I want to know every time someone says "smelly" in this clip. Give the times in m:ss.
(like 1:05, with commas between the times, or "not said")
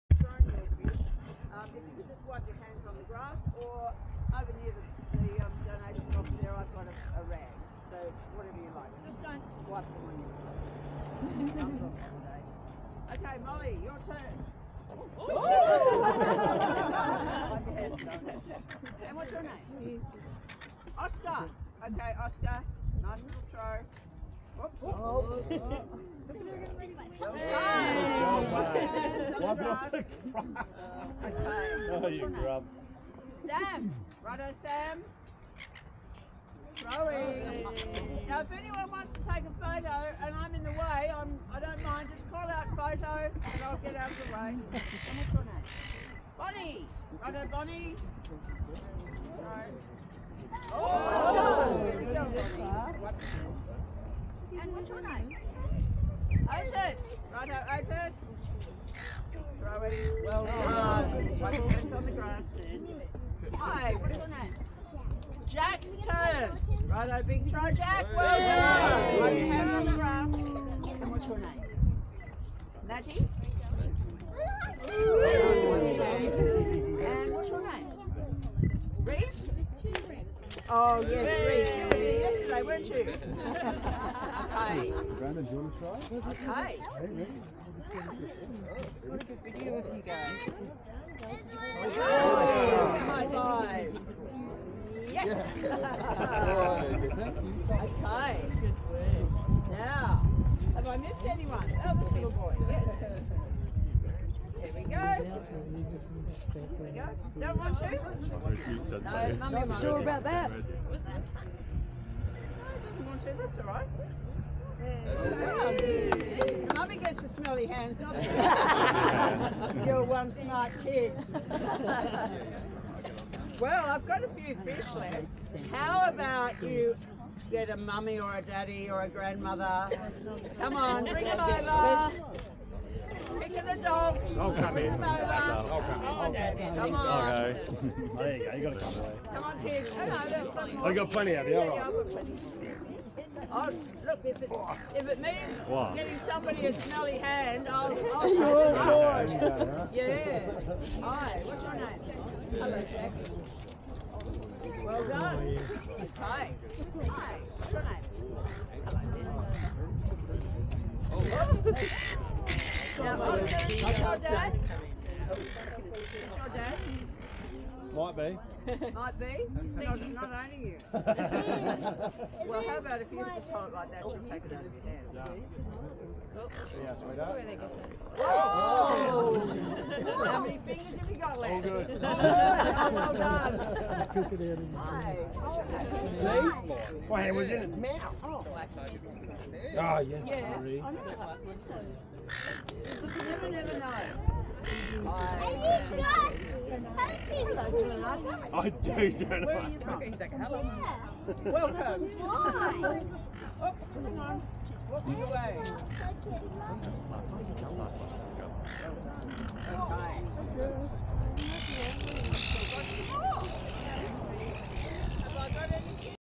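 1:57, 2:26.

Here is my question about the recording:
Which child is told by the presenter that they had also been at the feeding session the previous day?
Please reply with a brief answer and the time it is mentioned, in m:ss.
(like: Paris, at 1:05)
Reese, at 1:21.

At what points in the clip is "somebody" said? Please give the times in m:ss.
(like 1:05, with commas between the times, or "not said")
2:26.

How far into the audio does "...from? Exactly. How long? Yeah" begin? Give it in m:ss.
3:19.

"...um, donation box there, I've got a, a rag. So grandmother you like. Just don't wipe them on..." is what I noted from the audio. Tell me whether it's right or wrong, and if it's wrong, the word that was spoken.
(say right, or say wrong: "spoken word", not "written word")
wrong: "whatever", not "grandmother".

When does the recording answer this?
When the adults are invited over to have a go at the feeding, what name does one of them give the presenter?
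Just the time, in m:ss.
2:32.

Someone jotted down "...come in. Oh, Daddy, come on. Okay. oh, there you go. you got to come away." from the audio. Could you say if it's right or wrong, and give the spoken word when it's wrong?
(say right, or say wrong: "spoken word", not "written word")
right.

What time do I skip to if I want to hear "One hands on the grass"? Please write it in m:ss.
1:09.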